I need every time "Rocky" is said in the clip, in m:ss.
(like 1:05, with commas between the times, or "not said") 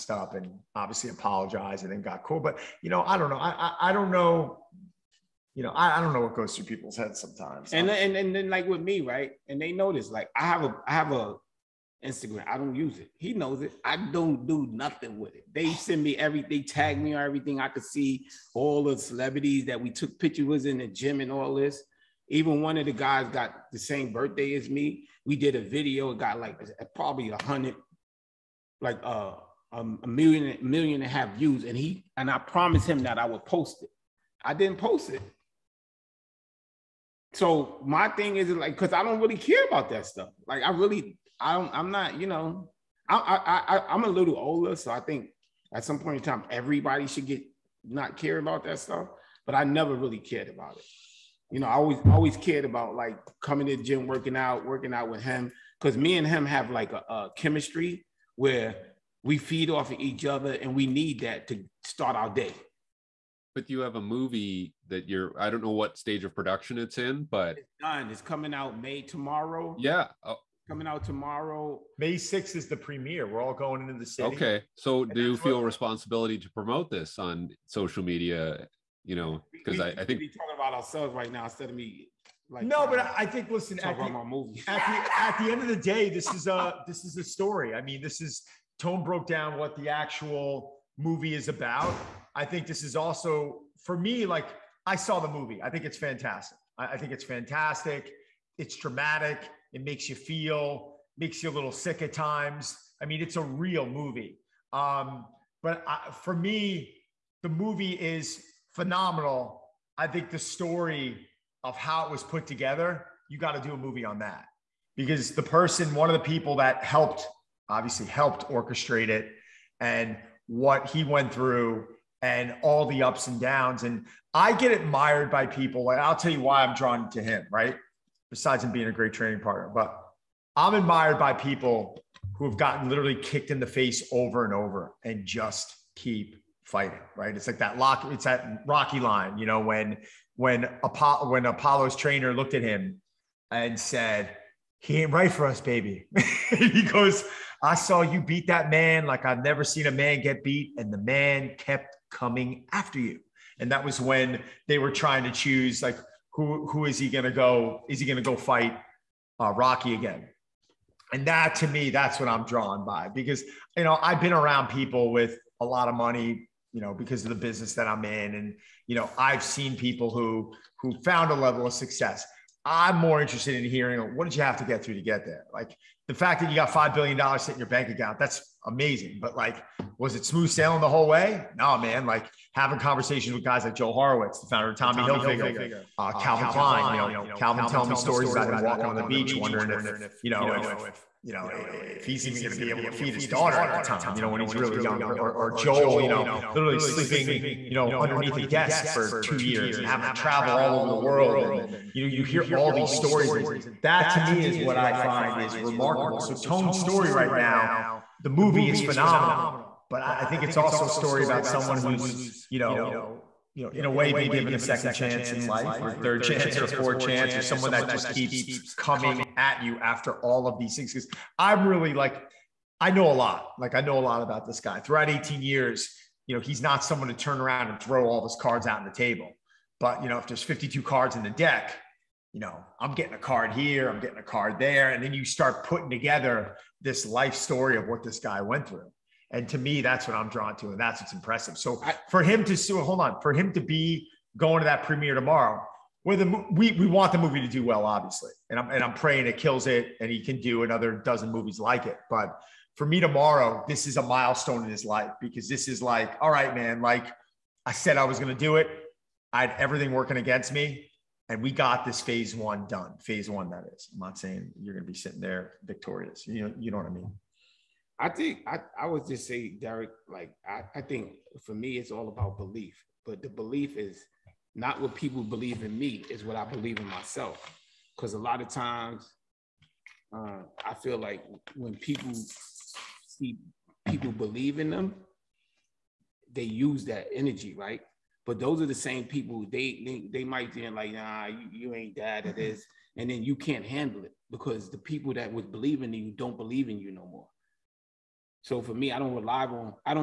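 2:18, 2:39.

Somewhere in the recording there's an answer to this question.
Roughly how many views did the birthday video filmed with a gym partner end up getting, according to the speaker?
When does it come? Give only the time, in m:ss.
0:30.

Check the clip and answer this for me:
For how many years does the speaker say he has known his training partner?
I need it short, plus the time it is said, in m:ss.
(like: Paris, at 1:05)
18, at 3:45.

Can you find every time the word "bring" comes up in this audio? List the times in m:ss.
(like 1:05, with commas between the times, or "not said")
not said.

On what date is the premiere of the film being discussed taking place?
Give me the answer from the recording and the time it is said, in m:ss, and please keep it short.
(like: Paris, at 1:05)
May 6th, at 1:11.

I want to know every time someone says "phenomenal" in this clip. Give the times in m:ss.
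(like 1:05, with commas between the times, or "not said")
1:48, 3:28.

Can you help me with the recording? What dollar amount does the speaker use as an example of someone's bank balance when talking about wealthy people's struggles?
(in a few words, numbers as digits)
$5 billion.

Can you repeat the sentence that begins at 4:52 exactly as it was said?
this, and then you can't handle it because the people that was believing in you don't believe in you no more.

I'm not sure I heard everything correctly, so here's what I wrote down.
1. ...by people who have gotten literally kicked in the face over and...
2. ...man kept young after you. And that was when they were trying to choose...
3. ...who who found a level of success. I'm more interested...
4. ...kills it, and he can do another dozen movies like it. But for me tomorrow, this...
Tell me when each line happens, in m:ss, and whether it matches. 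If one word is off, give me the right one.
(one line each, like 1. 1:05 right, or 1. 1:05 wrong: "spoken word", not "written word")
1. 2:11 right
2. 2:30 wrong: "coming", not "young"
3. 2:50 right
4. 4:09 right.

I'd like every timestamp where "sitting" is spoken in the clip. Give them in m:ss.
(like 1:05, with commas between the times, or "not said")
2:57, 4:24.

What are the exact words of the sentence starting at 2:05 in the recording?
And I'll tell you why I'm drawn to him, right?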